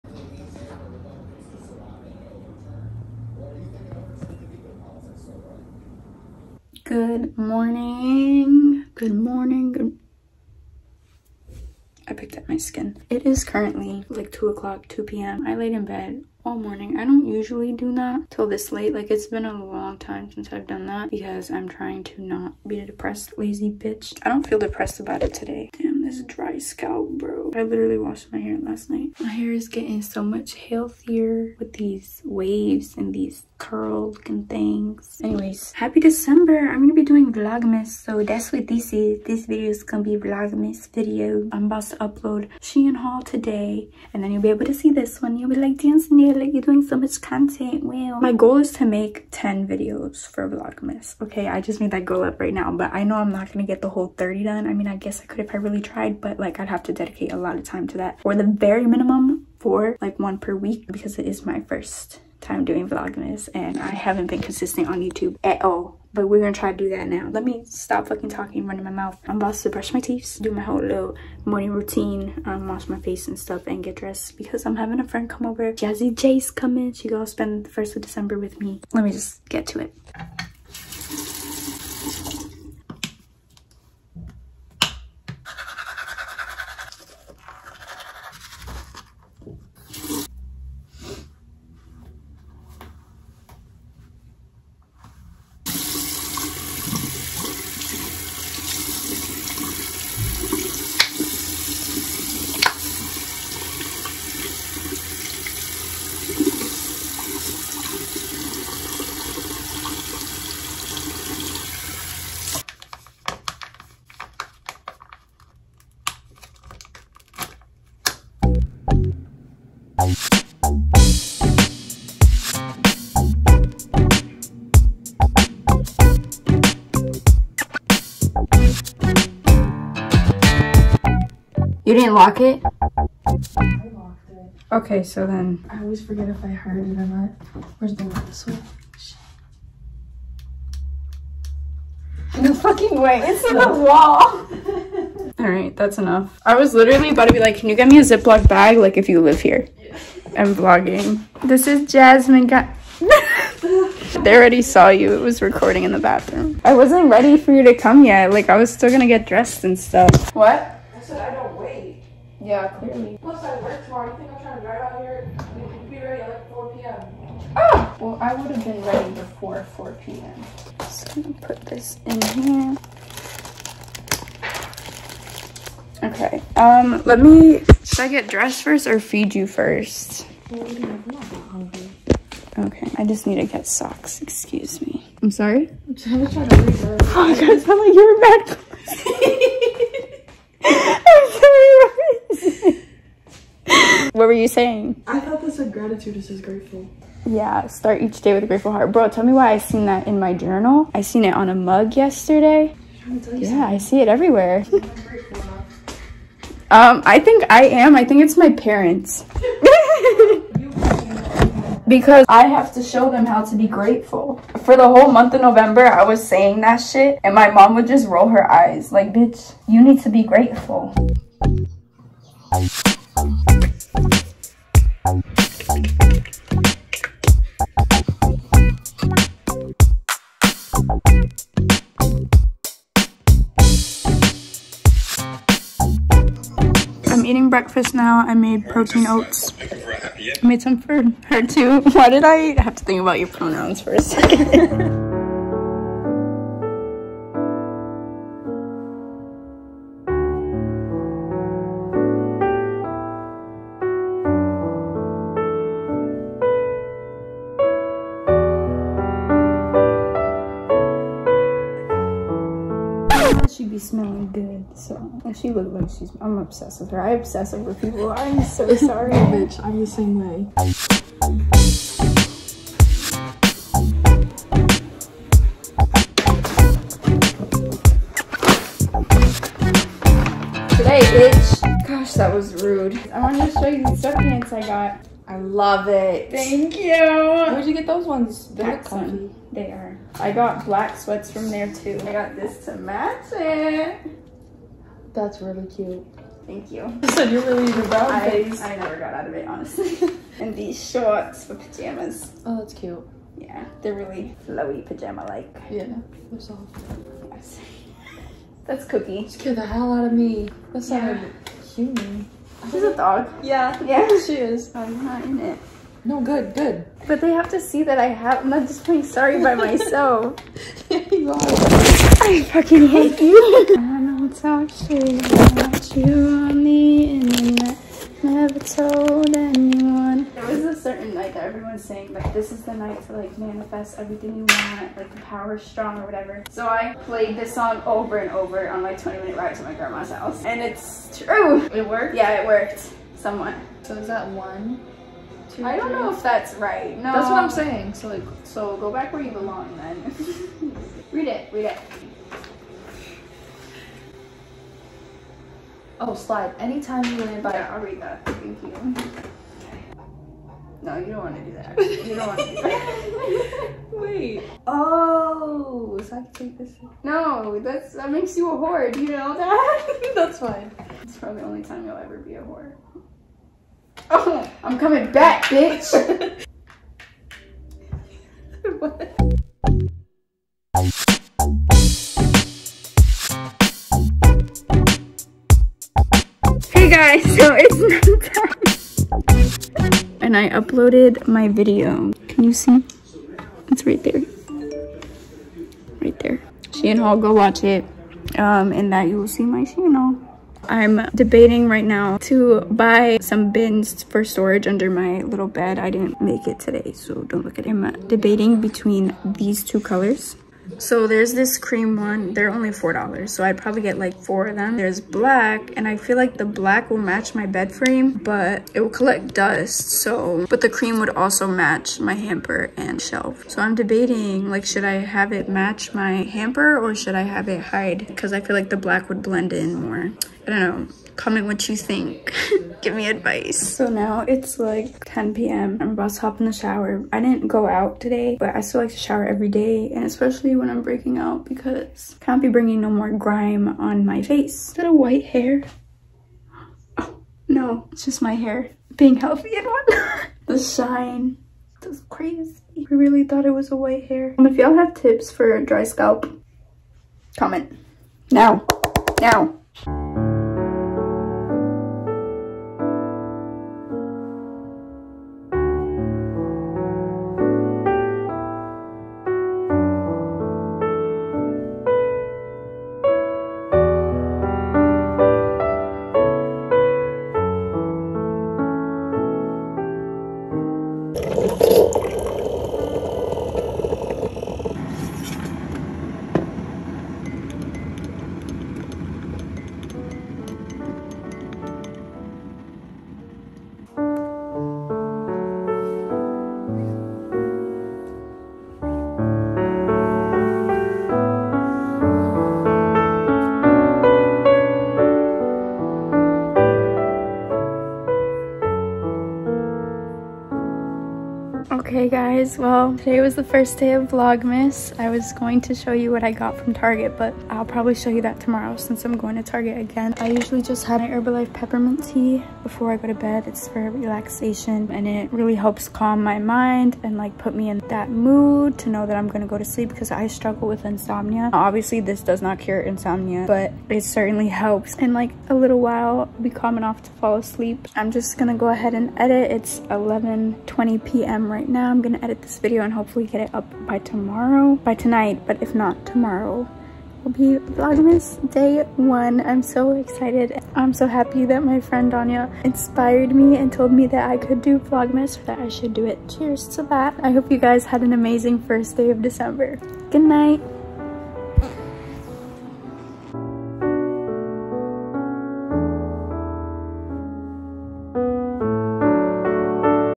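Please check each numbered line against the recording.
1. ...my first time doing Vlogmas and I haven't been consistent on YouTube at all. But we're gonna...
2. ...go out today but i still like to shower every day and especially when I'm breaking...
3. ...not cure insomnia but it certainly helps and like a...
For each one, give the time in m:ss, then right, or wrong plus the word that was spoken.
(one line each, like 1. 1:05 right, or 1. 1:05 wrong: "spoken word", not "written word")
1. 1:01 right
2. 7:17 right
3. 8:52 right.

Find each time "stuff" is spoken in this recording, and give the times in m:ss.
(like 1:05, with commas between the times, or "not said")
1:13, 2:39.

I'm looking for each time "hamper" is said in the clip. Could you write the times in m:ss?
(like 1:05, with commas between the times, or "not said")
7:02, 7:06.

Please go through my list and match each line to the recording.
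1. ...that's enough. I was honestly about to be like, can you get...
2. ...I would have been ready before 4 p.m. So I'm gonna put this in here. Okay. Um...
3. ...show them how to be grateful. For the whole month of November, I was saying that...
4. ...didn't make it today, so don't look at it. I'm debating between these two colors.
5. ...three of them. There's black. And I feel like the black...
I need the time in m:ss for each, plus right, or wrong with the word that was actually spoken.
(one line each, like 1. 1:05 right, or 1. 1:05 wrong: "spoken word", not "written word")
1. 2:25 wrong: "literally", not "honestly"
2. 2:48 right
3. 3:32 right
4. 6:45 right
5. 6:54 wrong: "four", not "three".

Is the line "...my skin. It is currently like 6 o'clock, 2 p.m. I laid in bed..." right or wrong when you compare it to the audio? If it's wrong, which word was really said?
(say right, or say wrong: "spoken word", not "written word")
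wrong: "2", not "6".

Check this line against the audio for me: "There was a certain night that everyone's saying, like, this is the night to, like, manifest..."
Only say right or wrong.
right.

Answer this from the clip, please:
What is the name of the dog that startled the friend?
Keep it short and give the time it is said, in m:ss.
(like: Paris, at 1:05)
Cookie, at 5:08.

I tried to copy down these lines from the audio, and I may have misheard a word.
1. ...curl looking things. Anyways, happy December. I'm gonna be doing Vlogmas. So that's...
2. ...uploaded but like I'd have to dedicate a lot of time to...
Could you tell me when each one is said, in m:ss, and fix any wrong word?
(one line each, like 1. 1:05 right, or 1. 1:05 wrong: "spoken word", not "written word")
1. 0:33 right
2. 0:55 wrong: "tried", not "uploaded".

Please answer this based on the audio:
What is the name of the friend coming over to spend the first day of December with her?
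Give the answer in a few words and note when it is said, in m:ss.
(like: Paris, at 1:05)
Jazzy J, at 1:15.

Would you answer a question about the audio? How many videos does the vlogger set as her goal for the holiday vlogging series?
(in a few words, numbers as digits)
10.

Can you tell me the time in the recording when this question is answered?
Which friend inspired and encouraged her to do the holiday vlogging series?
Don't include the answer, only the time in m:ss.
9:12.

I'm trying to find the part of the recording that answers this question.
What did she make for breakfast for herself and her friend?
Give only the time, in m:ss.
3:58.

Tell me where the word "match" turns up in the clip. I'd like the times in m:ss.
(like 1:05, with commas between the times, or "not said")
4:52, 6:56, 7:01, 7:05.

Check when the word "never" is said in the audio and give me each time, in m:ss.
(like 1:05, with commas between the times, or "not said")
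4:58, 5:28.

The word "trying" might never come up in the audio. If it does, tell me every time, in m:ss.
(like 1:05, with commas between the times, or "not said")
0:21, 2:44, 3:05.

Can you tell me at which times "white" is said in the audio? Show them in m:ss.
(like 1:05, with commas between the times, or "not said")
7:24, 7:33.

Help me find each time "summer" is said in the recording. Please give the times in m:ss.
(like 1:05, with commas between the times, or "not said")
not said.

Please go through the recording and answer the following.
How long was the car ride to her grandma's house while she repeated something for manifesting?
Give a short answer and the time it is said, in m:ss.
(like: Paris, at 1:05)
20 minutes, at 5:38.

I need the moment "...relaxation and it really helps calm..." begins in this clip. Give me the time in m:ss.
8:43.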